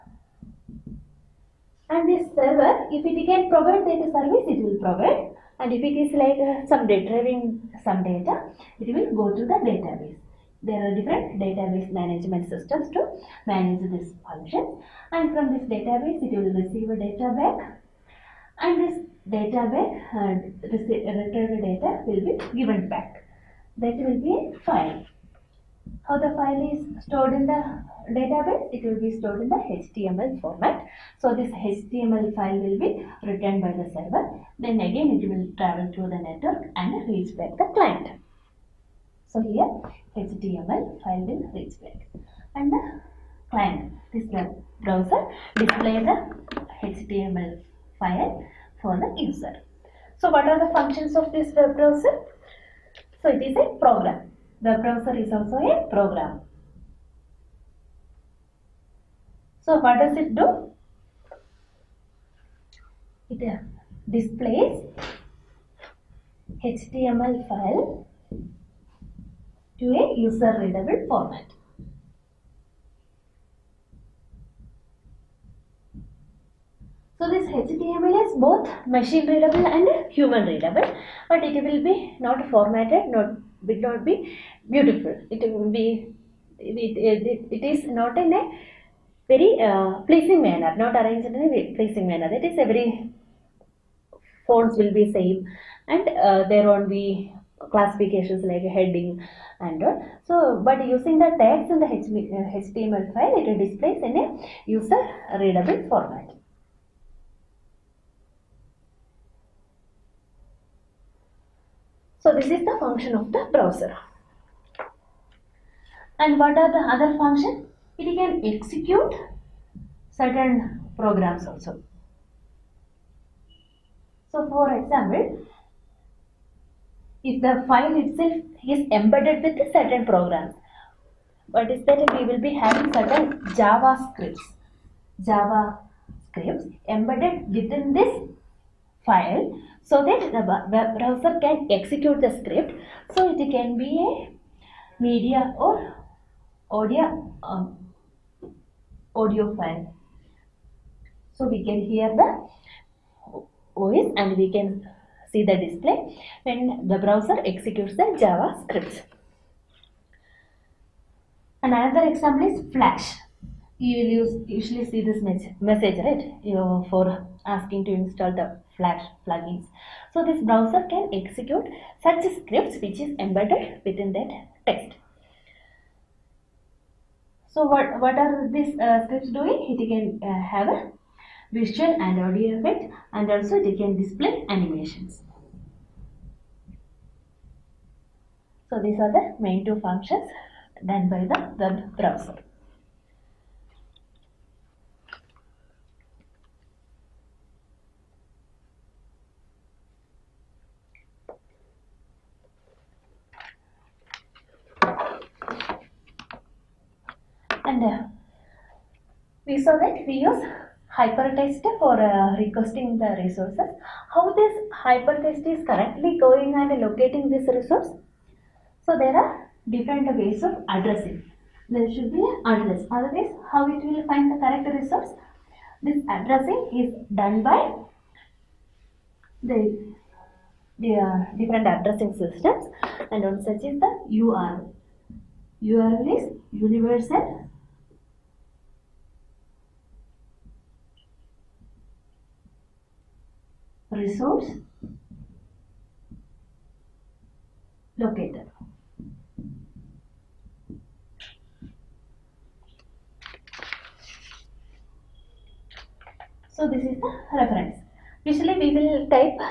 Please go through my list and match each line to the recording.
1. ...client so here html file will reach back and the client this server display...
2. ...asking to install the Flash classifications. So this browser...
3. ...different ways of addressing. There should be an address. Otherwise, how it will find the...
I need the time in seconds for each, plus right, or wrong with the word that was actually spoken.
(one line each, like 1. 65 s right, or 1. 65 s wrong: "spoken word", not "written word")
1. 37 s wrong: "browser", not "server"
2. 167 s wrong: "plugins", not "classifications"
3. 219 s right.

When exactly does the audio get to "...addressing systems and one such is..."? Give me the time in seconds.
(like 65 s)
231 s.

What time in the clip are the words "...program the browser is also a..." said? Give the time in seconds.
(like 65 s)
53 s.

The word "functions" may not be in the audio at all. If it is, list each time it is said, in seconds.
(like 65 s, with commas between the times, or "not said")
14 s, 50 s, 112 s, 117 s, 189 s.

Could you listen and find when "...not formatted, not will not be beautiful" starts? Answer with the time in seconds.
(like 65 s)
82 s.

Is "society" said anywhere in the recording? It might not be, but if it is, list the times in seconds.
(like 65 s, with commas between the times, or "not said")
not said.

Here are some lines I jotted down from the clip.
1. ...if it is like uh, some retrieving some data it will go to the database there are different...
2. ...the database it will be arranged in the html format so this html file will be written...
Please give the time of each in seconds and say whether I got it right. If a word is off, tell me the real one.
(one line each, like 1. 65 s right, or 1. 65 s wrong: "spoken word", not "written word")
1. 5 s right
2. 27 s wrong: "stored", not "arranged".